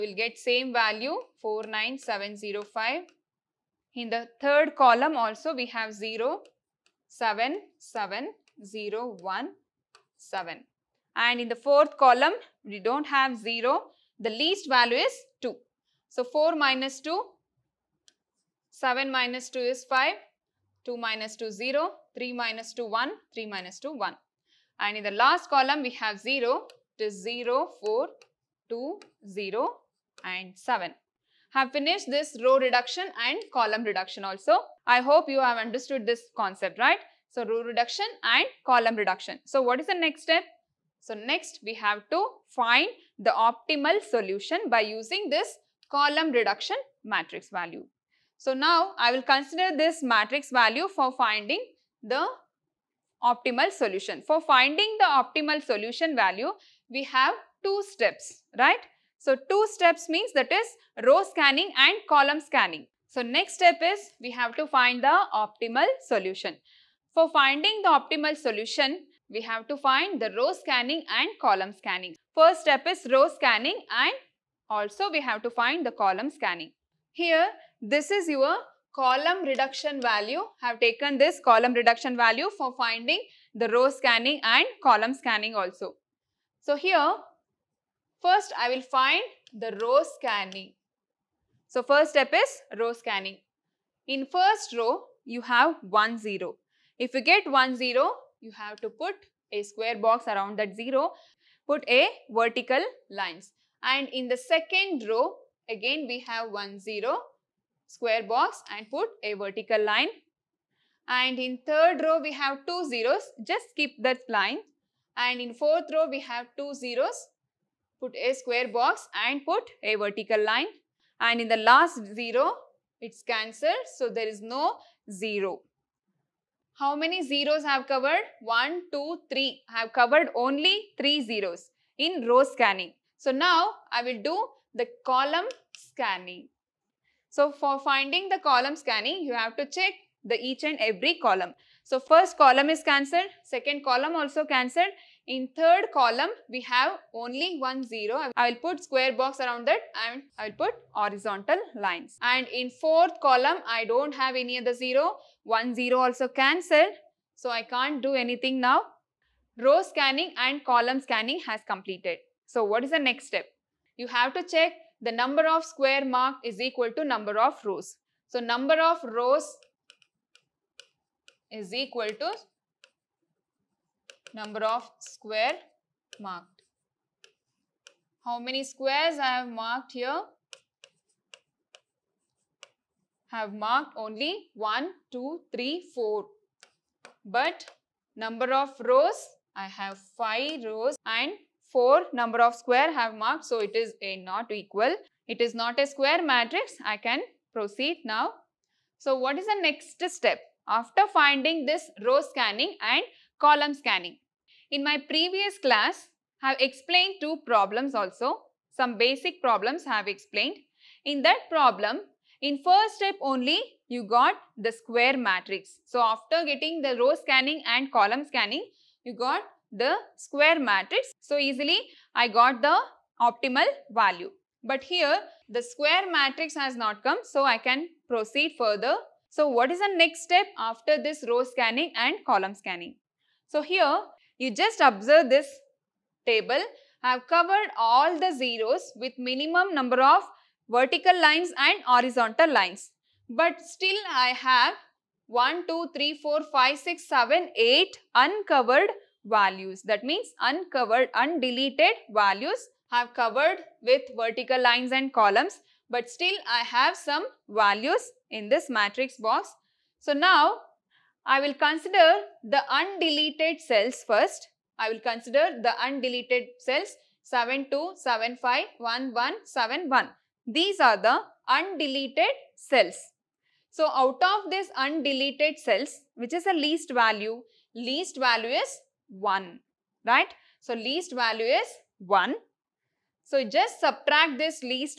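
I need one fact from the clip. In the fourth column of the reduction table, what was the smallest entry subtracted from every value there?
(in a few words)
2.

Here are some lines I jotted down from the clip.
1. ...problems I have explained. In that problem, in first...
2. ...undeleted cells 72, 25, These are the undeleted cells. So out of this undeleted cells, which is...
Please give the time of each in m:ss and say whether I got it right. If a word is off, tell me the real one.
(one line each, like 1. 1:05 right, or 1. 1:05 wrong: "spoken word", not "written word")
1. 3:29 right
2. 4:25 wrong: "75", not "25".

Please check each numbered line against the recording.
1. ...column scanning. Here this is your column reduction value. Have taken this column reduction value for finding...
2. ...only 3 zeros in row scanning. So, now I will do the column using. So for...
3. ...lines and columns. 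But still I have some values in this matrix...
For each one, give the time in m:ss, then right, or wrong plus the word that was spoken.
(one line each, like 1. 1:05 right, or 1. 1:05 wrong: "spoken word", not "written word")
1. 1:15 right
2. 2:10 wrong: "scanning", not "using"
3. 4:14 right.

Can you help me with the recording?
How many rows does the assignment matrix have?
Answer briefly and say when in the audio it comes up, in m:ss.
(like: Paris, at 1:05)
5, at 3:09.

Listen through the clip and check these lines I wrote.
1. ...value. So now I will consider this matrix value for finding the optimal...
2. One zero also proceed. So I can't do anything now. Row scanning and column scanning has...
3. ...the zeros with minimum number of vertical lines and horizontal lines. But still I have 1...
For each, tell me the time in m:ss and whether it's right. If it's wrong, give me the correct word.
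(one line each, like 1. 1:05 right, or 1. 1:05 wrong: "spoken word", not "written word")
1. 0:47 right
2. 2:35 wrong: "cancelled", not "proceed"
3. 3:58 right.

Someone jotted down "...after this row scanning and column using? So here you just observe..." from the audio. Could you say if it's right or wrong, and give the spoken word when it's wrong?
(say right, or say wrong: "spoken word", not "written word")
wrong: "scanning", not "using".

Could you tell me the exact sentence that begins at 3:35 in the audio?
So after getting the row scanning and column scanning, you got the square matrix.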